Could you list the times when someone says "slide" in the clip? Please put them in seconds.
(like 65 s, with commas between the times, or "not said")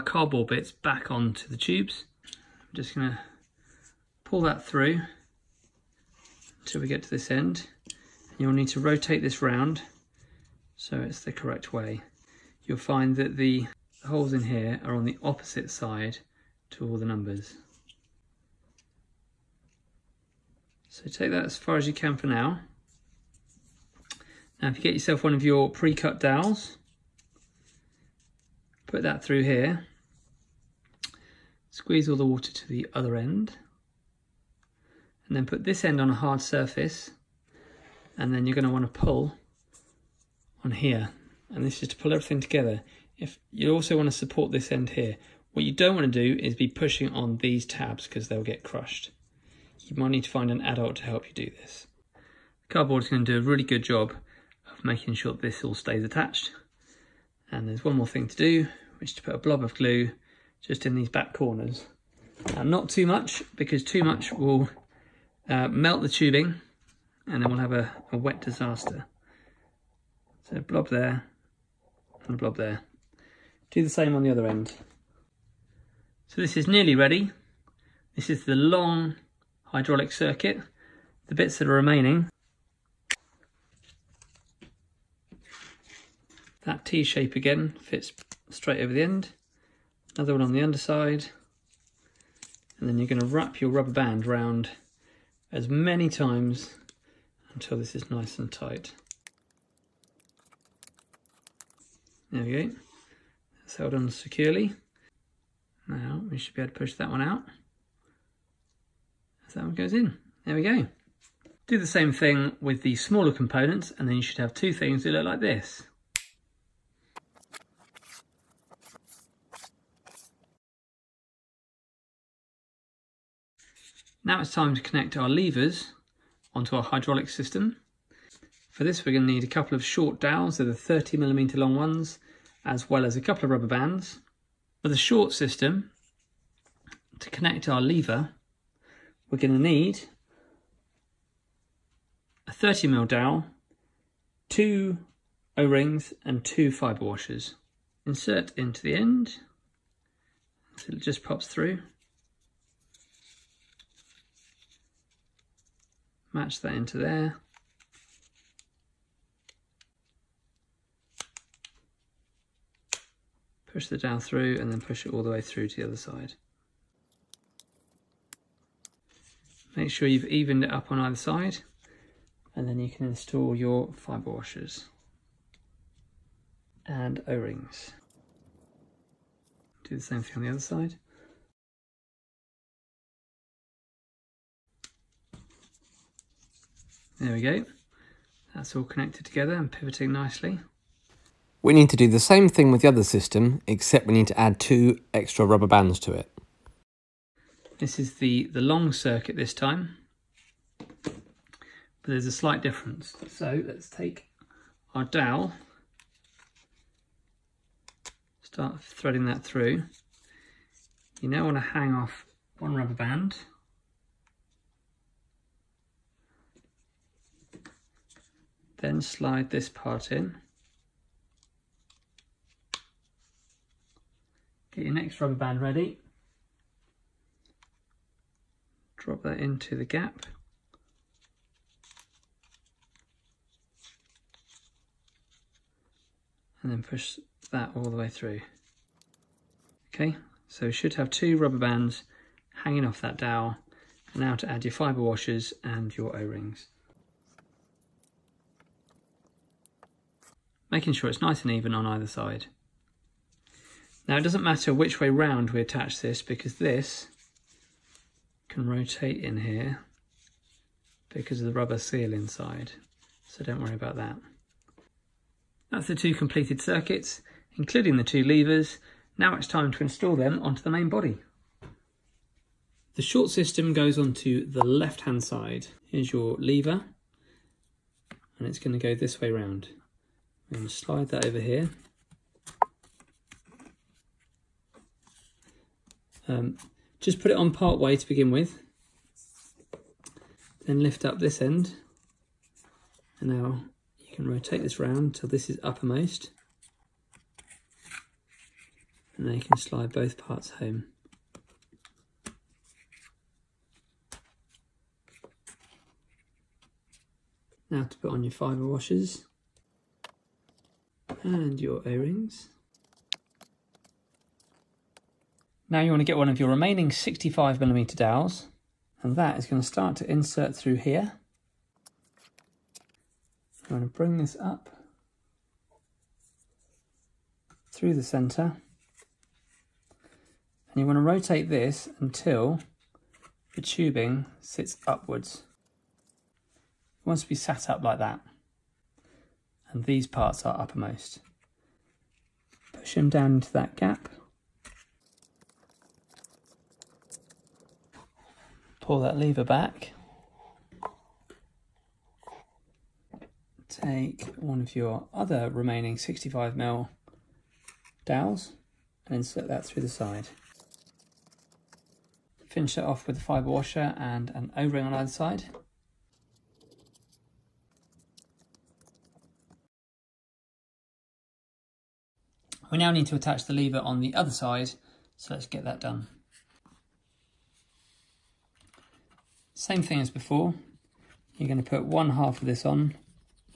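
219 s, 280 s, 299 s.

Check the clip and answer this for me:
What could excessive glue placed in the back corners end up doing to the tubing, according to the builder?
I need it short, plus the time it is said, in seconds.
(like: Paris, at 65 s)
melt the tubing, at 65 s.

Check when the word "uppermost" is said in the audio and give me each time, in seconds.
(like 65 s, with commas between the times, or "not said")
295 s, 340 s.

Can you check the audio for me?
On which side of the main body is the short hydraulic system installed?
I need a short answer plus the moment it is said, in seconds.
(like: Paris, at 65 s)
left-hand side, at 274 s.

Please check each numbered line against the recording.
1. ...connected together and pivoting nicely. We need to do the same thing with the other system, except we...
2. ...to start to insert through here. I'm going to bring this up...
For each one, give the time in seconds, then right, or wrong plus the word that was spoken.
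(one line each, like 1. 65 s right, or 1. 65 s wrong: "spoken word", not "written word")
1. 188 s right
2. 319 s right.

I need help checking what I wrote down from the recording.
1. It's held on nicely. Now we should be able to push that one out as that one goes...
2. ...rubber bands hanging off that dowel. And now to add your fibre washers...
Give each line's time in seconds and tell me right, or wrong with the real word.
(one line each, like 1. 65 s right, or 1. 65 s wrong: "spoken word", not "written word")
1. 103 s wrong: "securely", not "nicely"
2. 241 s right.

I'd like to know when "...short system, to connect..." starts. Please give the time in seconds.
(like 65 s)
134 s.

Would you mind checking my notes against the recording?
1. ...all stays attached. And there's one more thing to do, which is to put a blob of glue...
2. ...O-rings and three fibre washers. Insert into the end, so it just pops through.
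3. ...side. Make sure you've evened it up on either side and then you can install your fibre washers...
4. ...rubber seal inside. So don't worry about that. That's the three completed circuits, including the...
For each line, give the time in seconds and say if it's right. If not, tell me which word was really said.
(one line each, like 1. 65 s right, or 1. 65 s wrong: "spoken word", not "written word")
1. 55 s right
2. 145 s wrong: "two", not "three"
3. 165 s right
4. 261 s wrong: "two", not "three".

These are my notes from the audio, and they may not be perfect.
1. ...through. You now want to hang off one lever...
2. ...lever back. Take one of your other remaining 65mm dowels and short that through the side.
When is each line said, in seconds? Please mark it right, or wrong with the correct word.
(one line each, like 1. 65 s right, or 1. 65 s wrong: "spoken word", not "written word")
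1. 209 s wrong: "rubber", not "lever"
2. 349 s wrong: "insert", not "short".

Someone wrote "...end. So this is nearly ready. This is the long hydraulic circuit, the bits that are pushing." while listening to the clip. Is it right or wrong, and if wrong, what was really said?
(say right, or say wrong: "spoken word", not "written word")
wrong: "remaining", not "pushing".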